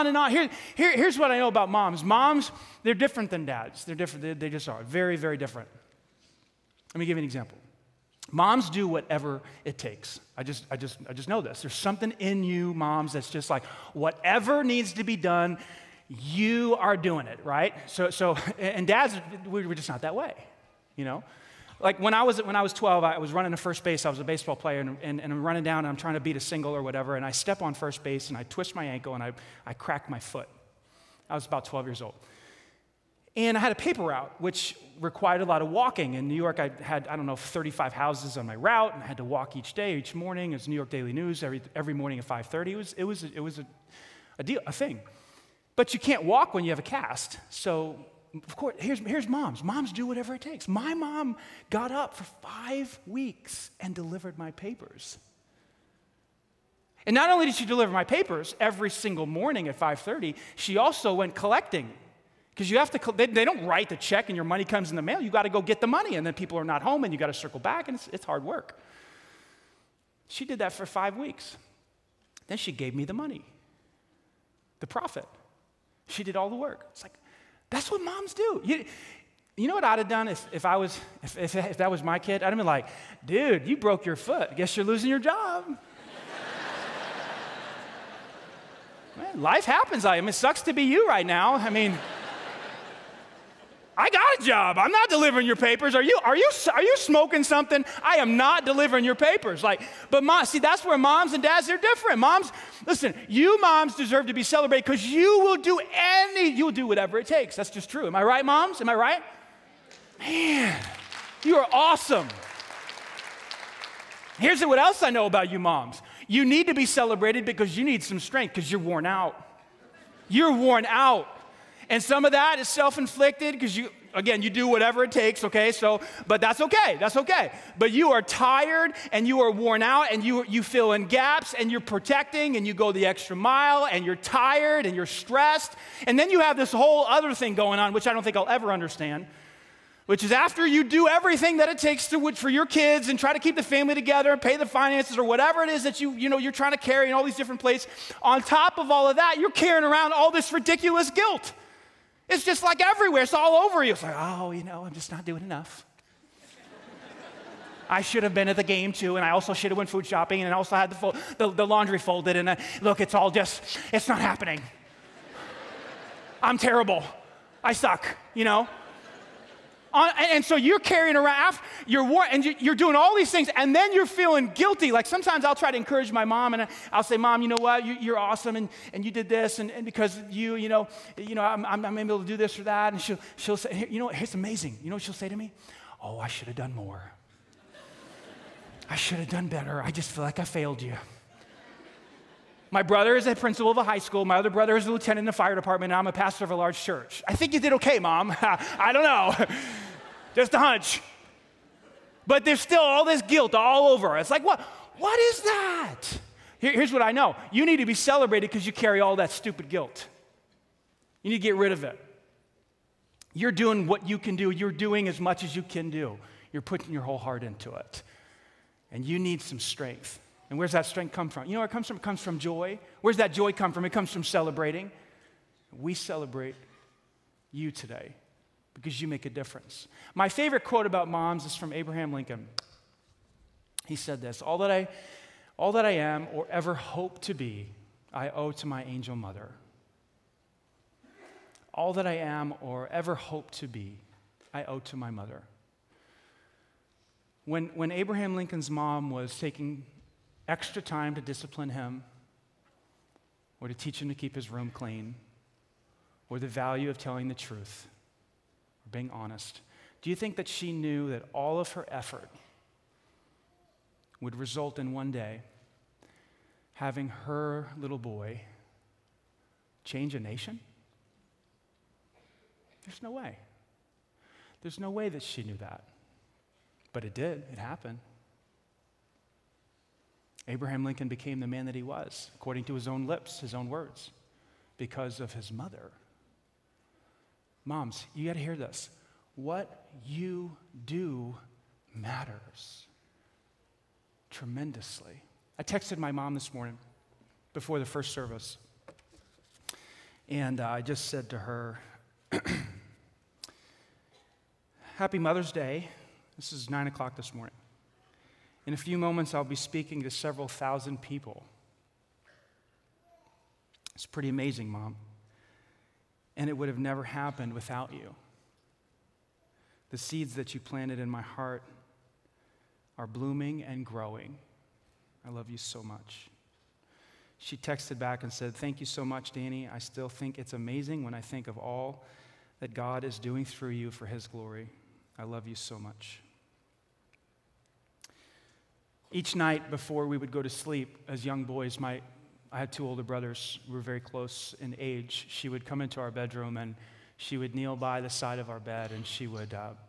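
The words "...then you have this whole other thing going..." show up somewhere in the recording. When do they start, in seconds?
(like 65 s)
136 s.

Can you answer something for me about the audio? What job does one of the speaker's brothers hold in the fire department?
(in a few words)
lieutenant.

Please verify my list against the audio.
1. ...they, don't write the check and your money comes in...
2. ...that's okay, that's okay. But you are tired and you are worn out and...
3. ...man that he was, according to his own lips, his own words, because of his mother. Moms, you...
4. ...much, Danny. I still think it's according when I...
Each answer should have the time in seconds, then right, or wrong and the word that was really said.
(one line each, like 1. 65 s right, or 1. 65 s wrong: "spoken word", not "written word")
1. 63 s right
2. 126 s right
3. 281 s right
4. 329 s wrong: "amazing", not "according".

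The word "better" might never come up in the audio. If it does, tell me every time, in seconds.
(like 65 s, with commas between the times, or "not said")
189 s.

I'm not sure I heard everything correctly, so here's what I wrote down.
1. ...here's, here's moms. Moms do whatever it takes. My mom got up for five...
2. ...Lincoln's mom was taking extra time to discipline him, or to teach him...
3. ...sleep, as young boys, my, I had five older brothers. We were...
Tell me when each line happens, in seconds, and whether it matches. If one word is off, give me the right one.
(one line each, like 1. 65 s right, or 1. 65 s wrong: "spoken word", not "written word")
1. 48 s right
2. 248 s right
3. 340 s wrong: "two", not "five".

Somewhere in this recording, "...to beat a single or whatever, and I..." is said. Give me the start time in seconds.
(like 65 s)
26 s.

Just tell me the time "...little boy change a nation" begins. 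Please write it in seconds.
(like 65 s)
267 s.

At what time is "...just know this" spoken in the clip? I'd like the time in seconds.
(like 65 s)
11 s.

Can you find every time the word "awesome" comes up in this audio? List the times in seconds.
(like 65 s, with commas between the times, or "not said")
111 s, 178 s.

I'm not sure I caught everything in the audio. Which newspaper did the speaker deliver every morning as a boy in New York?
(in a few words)
New York Daily News.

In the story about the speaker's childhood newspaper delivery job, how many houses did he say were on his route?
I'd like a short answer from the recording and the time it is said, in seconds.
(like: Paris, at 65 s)
35, at 37 s.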